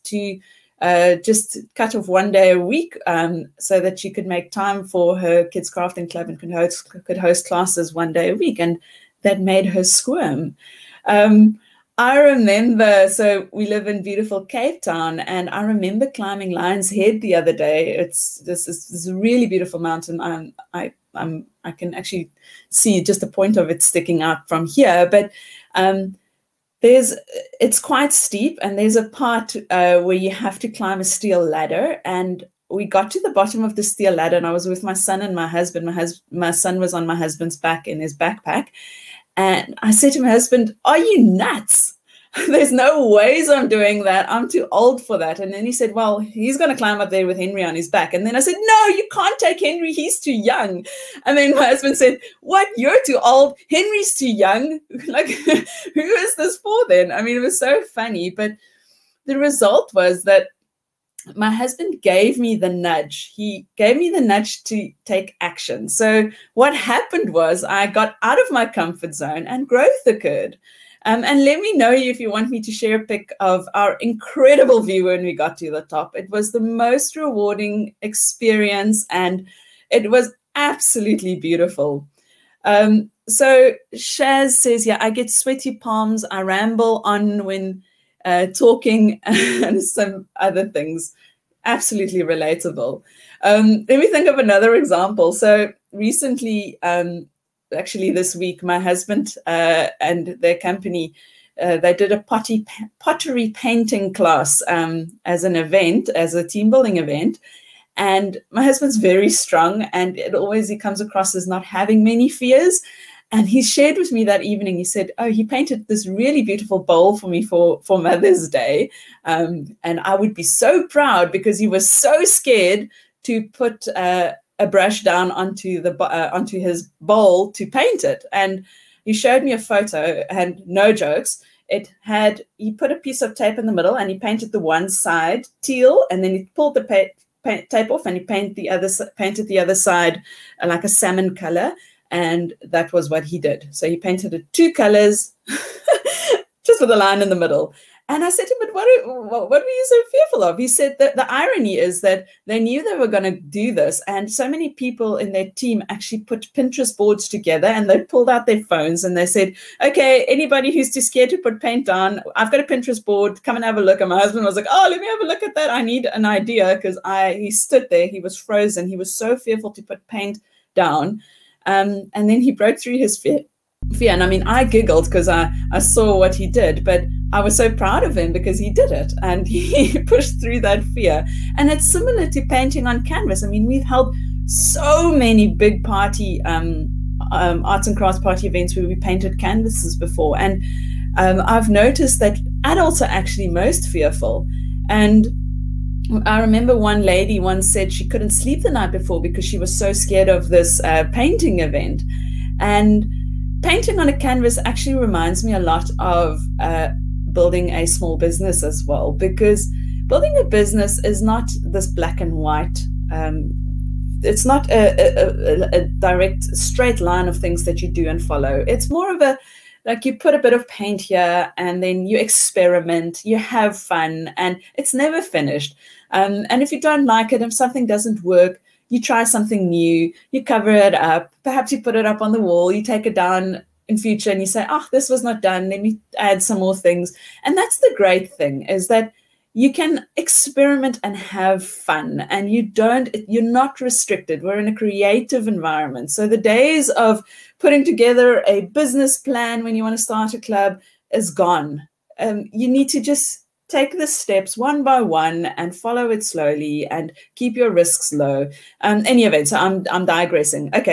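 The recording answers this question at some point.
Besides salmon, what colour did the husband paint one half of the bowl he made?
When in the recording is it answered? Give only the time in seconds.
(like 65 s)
135 s.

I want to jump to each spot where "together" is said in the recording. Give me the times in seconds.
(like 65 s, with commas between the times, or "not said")
157 s, 247 s.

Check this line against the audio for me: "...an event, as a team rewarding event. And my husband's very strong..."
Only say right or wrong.
wrong.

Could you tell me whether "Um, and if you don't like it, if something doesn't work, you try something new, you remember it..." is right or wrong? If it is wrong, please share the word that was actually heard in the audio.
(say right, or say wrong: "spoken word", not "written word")
wrong: "cover", not "remember".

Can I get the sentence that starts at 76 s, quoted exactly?
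It was the most rewarding experience and it was absolutely beautiful.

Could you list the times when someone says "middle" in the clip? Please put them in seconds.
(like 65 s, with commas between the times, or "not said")
133 s, 147 s.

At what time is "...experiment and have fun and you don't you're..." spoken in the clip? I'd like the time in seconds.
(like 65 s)
240 s.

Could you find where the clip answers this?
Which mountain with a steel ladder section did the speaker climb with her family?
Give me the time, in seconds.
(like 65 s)
16 s.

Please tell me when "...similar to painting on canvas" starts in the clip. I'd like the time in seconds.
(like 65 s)
181 s.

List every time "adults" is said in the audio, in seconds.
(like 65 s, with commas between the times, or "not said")
192 s.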